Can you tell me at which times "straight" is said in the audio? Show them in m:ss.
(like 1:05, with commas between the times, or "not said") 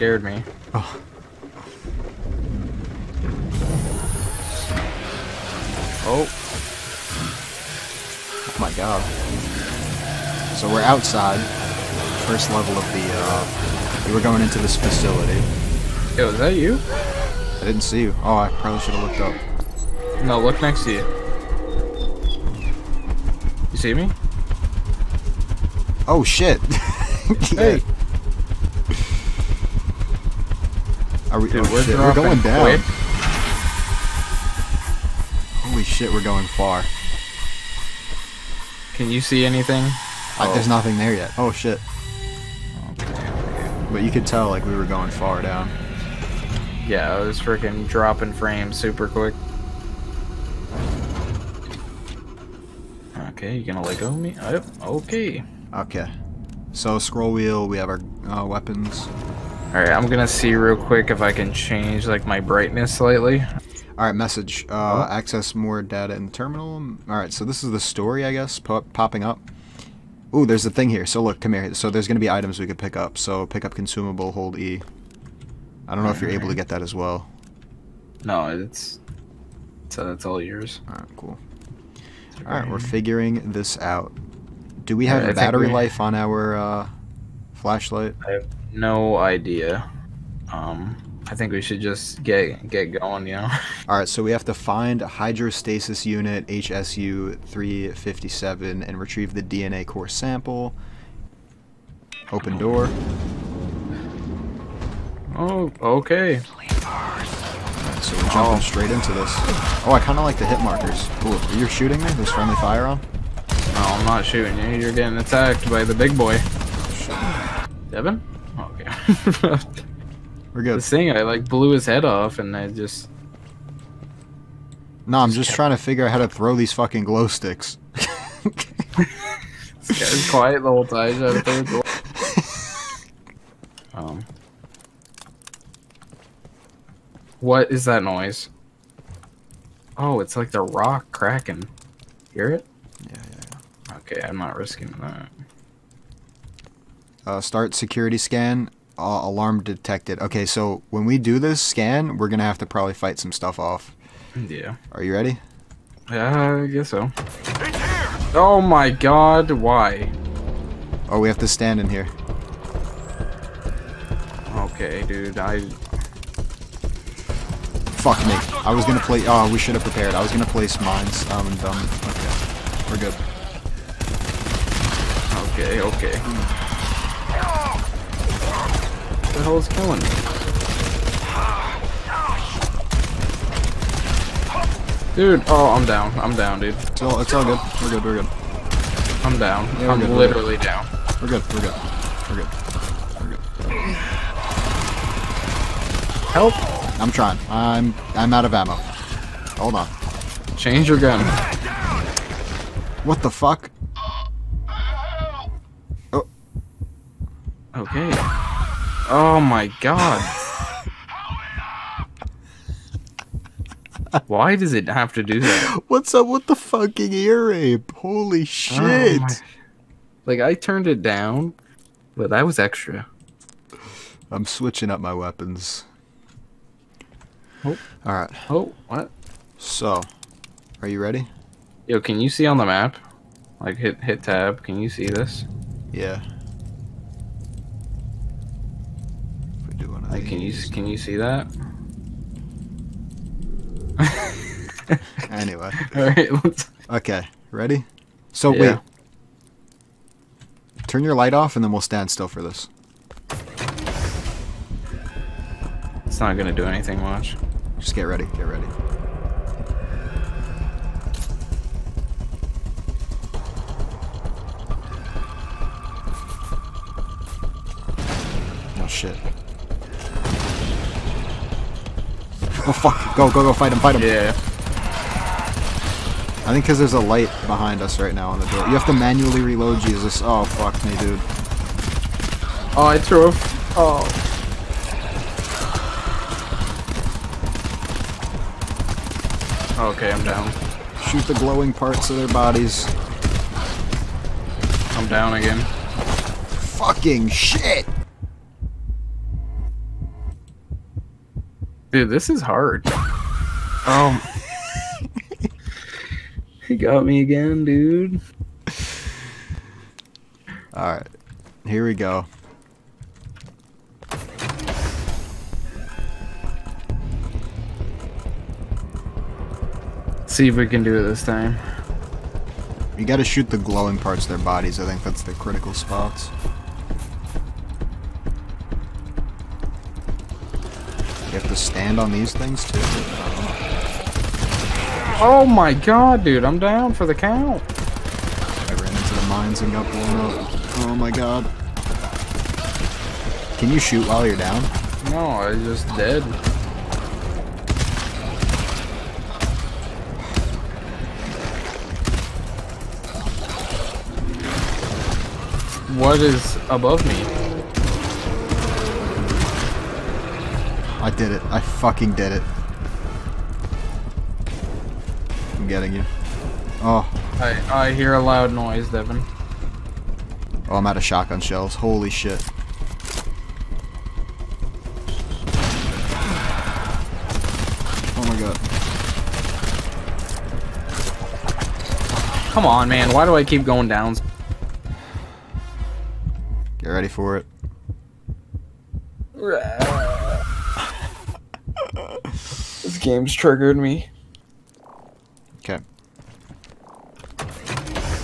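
1:48.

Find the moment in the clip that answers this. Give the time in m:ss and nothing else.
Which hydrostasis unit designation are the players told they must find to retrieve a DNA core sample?
1:36.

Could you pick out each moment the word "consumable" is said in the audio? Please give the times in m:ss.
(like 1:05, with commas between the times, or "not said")
1:13.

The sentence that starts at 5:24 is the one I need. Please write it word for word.
I think that's the critical spots.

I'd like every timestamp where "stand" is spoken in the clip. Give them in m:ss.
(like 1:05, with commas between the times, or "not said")
2:41, 4:11, 5:31.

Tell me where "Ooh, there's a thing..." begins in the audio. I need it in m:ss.
1:10.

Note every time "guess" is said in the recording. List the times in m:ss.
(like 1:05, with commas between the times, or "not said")
1:08, 2:36.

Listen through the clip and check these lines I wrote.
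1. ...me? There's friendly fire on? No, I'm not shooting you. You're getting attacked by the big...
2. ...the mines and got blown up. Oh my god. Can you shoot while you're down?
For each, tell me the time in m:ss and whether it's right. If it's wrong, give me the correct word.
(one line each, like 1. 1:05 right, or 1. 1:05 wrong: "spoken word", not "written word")
1. 1:52 right
2. 5:39 right.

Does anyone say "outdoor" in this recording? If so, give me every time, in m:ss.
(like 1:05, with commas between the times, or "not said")
not said.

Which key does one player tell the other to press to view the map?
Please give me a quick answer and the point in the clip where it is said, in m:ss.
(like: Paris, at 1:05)
tab, at 3:54.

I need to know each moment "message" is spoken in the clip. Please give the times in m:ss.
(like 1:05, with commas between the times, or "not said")
1:04.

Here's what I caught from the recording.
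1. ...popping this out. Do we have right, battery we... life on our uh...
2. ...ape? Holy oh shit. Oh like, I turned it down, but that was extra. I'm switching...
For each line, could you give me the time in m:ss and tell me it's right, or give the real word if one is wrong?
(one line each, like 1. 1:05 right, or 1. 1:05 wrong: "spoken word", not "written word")
1. 1:22 wrong: "figuring", not "popping"
2. 3:37 right.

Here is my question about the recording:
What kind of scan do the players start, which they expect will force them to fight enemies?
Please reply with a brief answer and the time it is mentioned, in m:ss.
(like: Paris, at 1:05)
security scan, at 2:27.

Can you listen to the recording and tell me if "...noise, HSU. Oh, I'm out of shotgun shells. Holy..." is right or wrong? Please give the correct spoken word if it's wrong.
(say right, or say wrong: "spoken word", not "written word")
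wrong: "Devin", not "HSU".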